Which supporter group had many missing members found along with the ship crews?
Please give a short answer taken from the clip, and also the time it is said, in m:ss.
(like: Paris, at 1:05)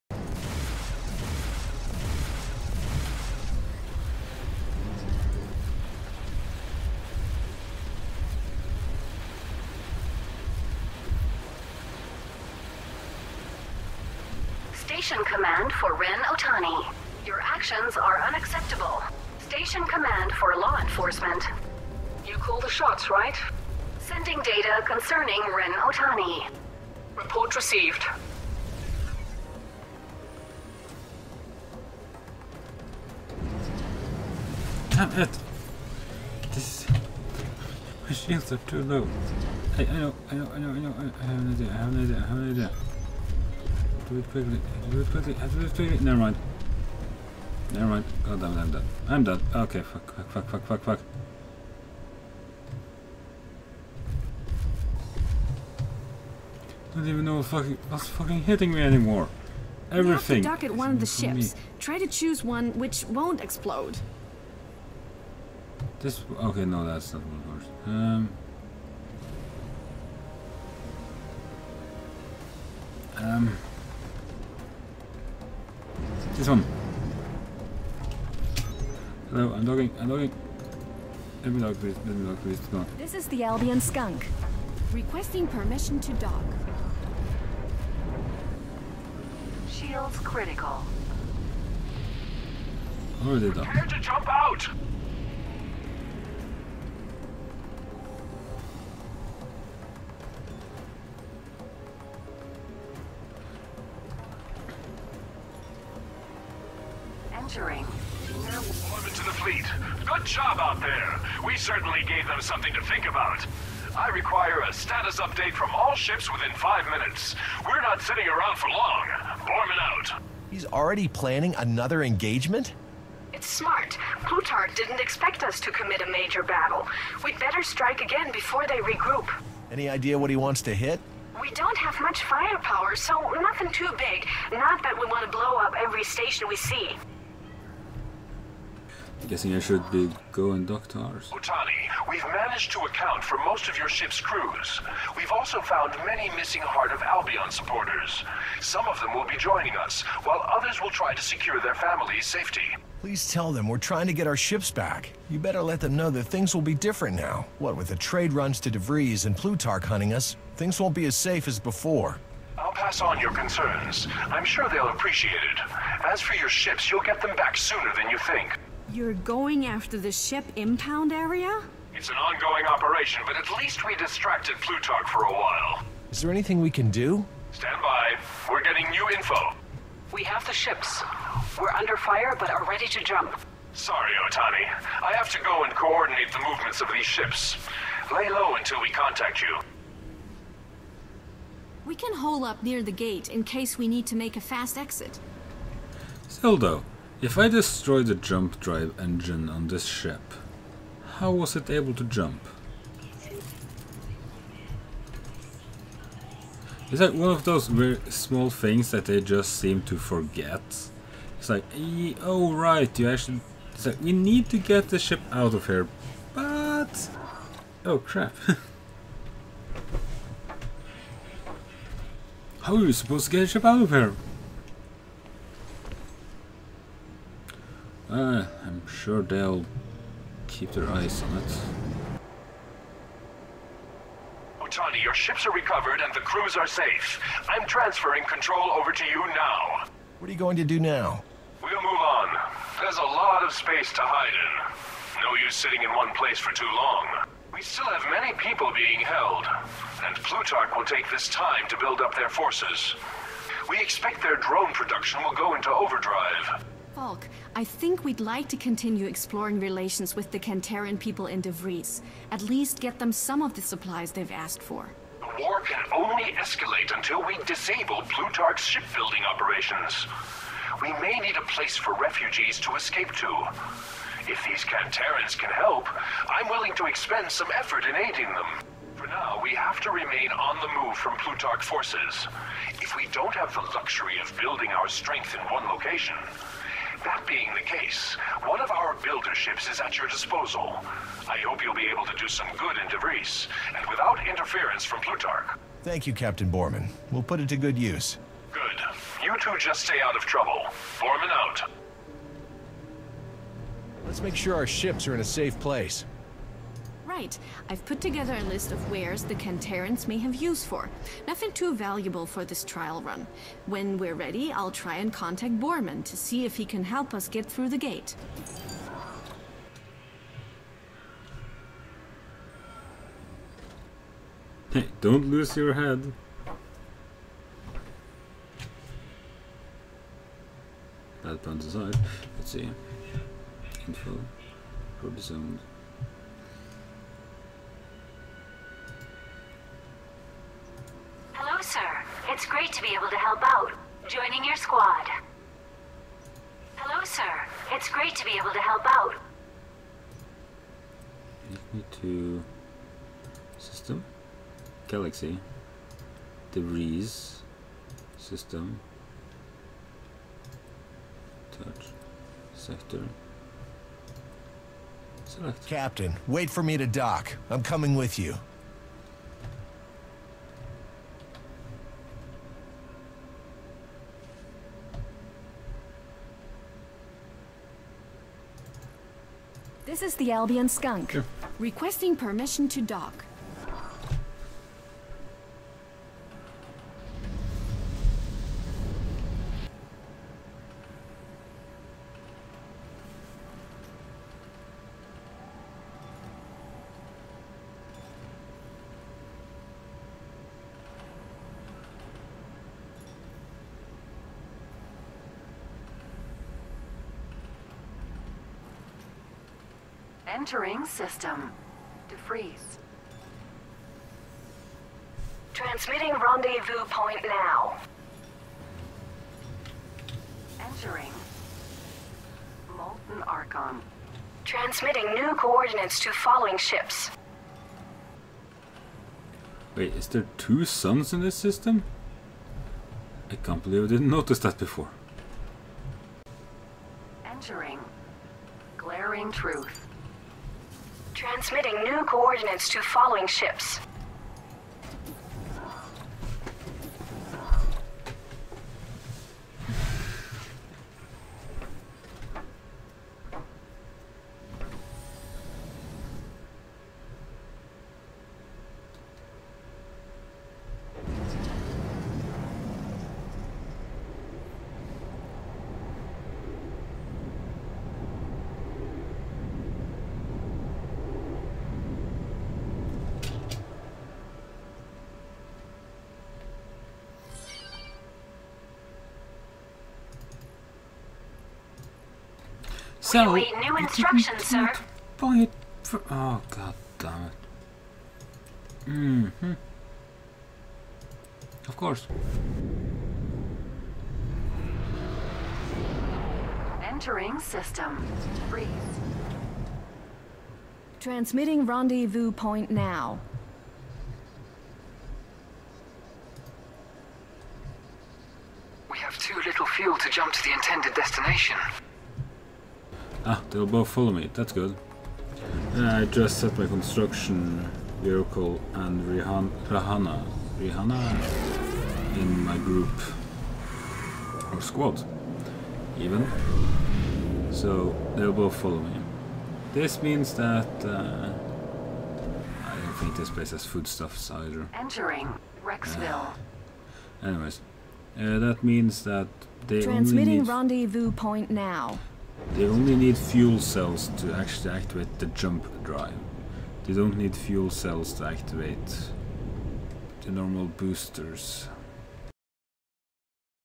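Heart of Albion, at 2:26.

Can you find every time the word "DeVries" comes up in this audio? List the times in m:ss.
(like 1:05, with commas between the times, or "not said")
2:38, 4:21, 4:52, 6:52.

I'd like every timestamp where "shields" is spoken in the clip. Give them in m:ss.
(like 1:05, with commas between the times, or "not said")
0:38, 1:29.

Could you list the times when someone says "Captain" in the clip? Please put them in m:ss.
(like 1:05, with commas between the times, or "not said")
4:56, 6:05.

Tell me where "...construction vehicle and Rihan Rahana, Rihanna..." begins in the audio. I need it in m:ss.
8:36.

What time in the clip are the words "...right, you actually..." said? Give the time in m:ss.
3:32.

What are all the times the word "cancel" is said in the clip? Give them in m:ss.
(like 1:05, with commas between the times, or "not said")
not said.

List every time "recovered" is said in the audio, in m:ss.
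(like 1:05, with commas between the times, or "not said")
3:55.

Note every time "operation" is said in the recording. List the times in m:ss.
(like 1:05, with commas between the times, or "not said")
2:52, 4:29.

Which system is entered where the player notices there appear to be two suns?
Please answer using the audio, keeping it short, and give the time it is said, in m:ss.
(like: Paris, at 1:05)
Molten Archon, at 7:02.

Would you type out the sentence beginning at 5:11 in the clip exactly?
Nothing too valuable for this trial run.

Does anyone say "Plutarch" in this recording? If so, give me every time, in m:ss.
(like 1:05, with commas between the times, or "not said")
2:04, 2:39, 2:54, 4:10, 4:28, 4:41, 4:54.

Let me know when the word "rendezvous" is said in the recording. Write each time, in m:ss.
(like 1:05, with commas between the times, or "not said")
6:56, 8:21, 9:00.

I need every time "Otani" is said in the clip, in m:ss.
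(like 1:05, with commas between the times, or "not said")
0:16, 0:25, 2:21, 3:04, 3:54.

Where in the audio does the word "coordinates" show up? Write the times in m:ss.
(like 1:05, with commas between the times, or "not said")
3:05, 7:05, 7:22.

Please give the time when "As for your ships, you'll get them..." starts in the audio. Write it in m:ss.
2:46.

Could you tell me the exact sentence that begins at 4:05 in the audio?
No use sitting in one place for too long.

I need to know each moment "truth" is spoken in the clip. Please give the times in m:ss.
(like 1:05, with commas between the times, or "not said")
7:19.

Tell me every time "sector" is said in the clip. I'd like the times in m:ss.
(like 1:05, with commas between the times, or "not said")
6:02.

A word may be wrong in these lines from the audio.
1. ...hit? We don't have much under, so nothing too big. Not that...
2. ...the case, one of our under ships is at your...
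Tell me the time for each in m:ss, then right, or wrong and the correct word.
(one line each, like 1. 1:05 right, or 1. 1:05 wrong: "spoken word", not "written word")
1. 2:10 wrong: "firepower", not "under"
2. 4:47 wrong: "builder", not "under".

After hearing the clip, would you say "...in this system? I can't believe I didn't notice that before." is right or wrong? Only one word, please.
right.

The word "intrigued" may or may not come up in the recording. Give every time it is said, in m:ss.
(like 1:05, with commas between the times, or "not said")
not said.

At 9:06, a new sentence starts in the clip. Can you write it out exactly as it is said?
They don't need fuel cells to activate the normal boosters.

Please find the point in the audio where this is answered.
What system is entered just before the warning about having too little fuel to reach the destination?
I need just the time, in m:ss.
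8:18.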